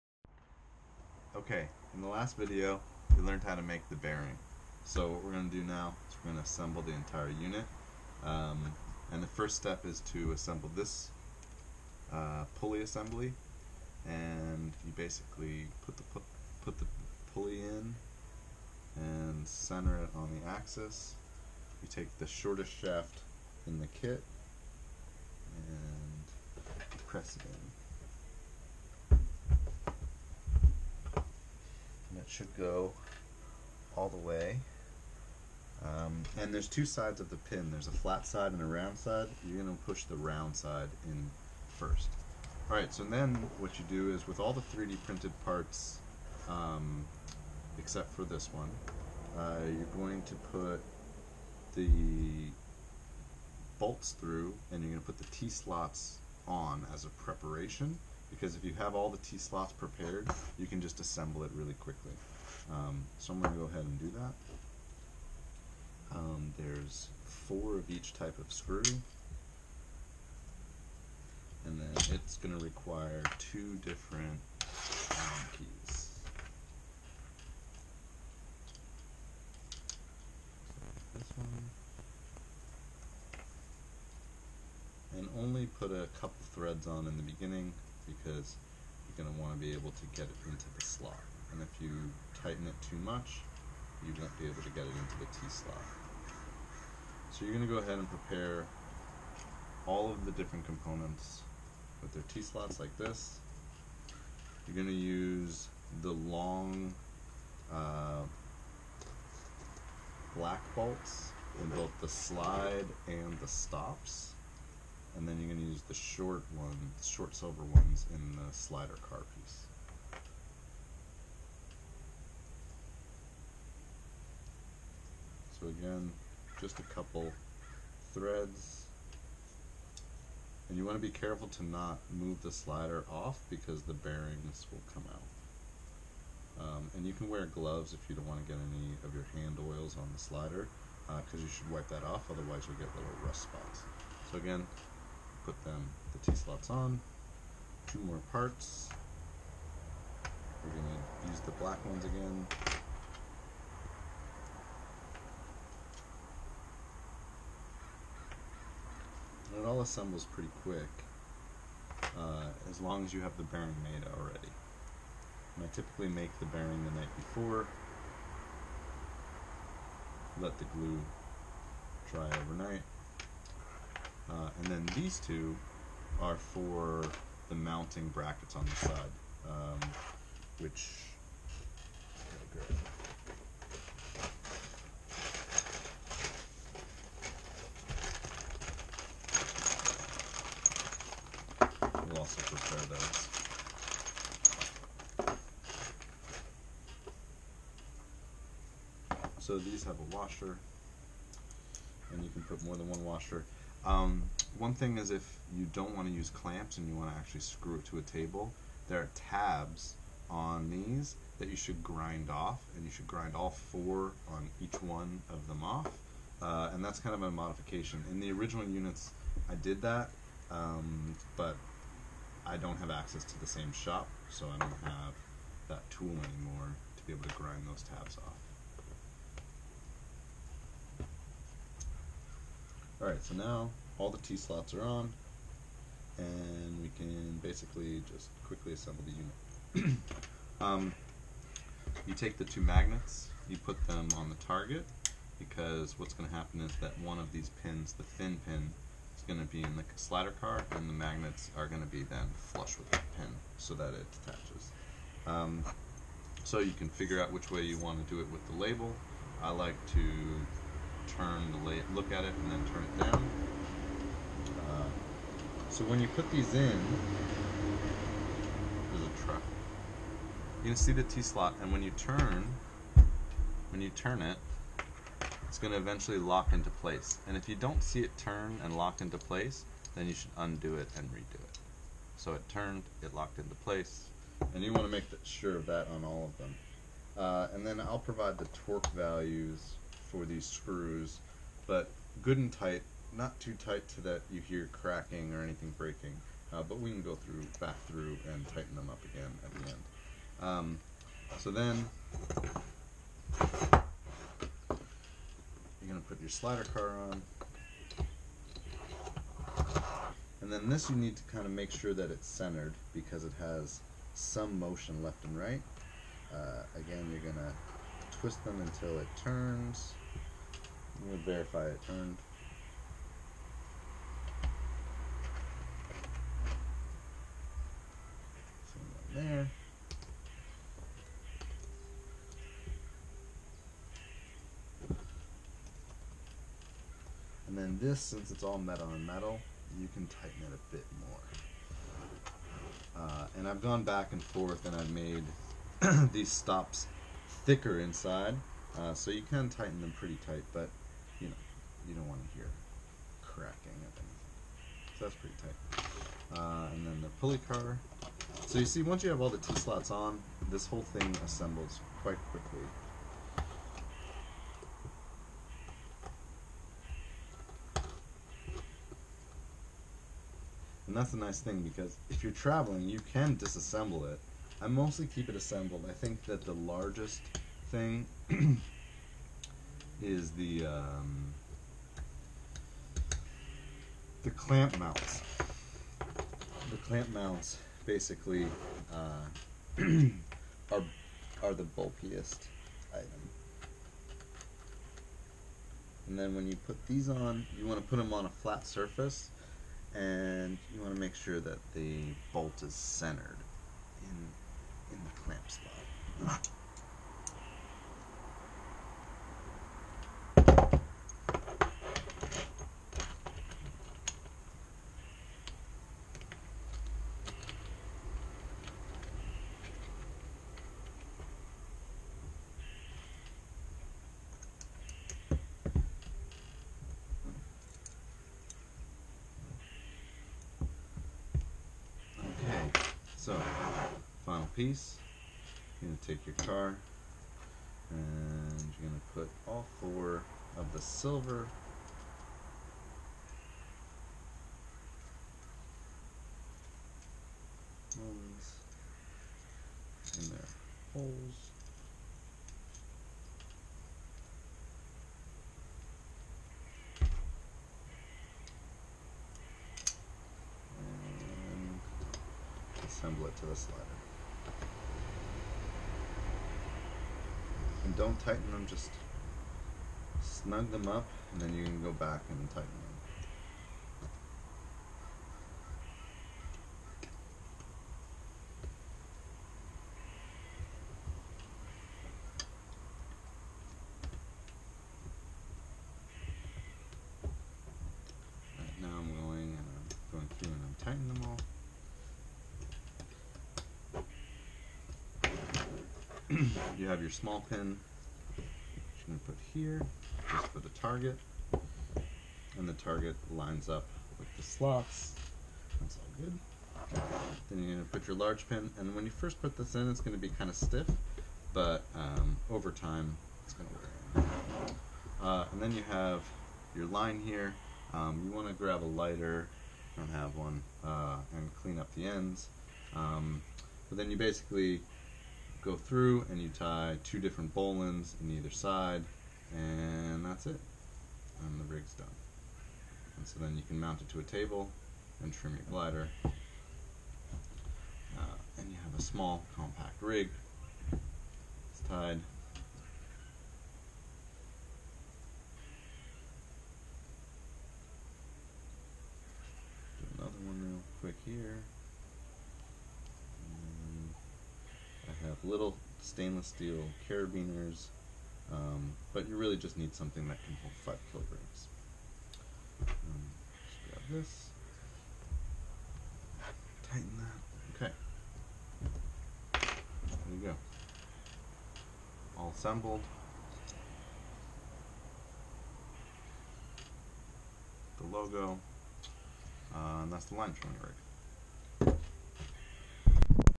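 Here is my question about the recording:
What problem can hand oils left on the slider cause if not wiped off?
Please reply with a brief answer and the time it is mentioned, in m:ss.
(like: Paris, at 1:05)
Rust spots, at 2:23.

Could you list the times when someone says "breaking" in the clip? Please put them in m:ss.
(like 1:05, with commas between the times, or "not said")
4:55.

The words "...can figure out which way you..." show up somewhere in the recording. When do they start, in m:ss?
4:16.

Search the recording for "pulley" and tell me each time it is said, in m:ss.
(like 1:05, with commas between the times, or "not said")
0:12, 0:17, 5:57.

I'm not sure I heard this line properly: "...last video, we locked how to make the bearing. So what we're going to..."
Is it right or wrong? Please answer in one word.
wrong.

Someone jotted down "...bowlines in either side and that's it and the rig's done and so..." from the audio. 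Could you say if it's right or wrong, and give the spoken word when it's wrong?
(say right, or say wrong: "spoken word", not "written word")
right.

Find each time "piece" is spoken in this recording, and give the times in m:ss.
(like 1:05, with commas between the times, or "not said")
1:59, 7:14.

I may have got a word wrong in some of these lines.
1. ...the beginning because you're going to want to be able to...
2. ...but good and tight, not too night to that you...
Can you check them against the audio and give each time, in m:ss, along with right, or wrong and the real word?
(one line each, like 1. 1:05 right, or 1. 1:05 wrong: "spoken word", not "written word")
1. 1:27 right
2. 4:51 wrong: "tight", not "night".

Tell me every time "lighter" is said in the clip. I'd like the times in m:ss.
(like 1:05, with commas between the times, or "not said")
8:38.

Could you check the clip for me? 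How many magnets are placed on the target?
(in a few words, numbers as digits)
2.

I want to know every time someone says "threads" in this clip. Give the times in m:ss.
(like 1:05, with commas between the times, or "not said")
1:26, 2:08.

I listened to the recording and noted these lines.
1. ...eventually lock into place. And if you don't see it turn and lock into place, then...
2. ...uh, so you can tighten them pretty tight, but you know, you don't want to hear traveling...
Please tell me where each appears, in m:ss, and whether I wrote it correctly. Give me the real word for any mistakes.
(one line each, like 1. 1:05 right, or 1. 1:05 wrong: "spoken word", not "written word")
1. 4:35 right
2. 5:48 wrong: "cracking", not "traveling".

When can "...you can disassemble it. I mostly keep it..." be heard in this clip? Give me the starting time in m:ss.
6:12.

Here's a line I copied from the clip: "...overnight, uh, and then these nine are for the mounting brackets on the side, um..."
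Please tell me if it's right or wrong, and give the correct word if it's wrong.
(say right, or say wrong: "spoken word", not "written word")
wrong: "two", not "nine".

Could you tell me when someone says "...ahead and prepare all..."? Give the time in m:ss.
1:37.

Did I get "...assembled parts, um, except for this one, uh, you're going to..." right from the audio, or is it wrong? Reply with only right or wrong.
wrong.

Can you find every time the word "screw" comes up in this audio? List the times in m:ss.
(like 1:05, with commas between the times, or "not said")
1:08, 3:27, 4:50.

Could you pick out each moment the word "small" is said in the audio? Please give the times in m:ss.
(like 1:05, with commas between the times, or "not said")
8:17, 8:59.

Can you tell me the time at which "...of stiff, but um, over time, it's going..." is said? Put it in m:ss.
8:30.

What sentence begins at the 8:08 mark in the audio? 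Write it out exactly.
Right now I'm going and uh, I'm going through and I'm tightening them all.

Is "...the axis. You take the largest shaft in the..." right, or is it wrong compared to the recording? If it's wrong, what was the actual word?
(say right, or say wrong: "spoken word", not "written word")
wrong: "shortest", not "largest".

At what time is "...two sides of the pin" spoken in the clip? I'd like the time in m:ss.
0:36.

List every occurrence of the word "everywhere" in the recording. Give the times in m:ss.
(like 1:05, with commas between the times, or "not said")
not said.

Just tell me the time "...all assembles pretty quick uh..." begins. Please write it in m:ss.
2:39.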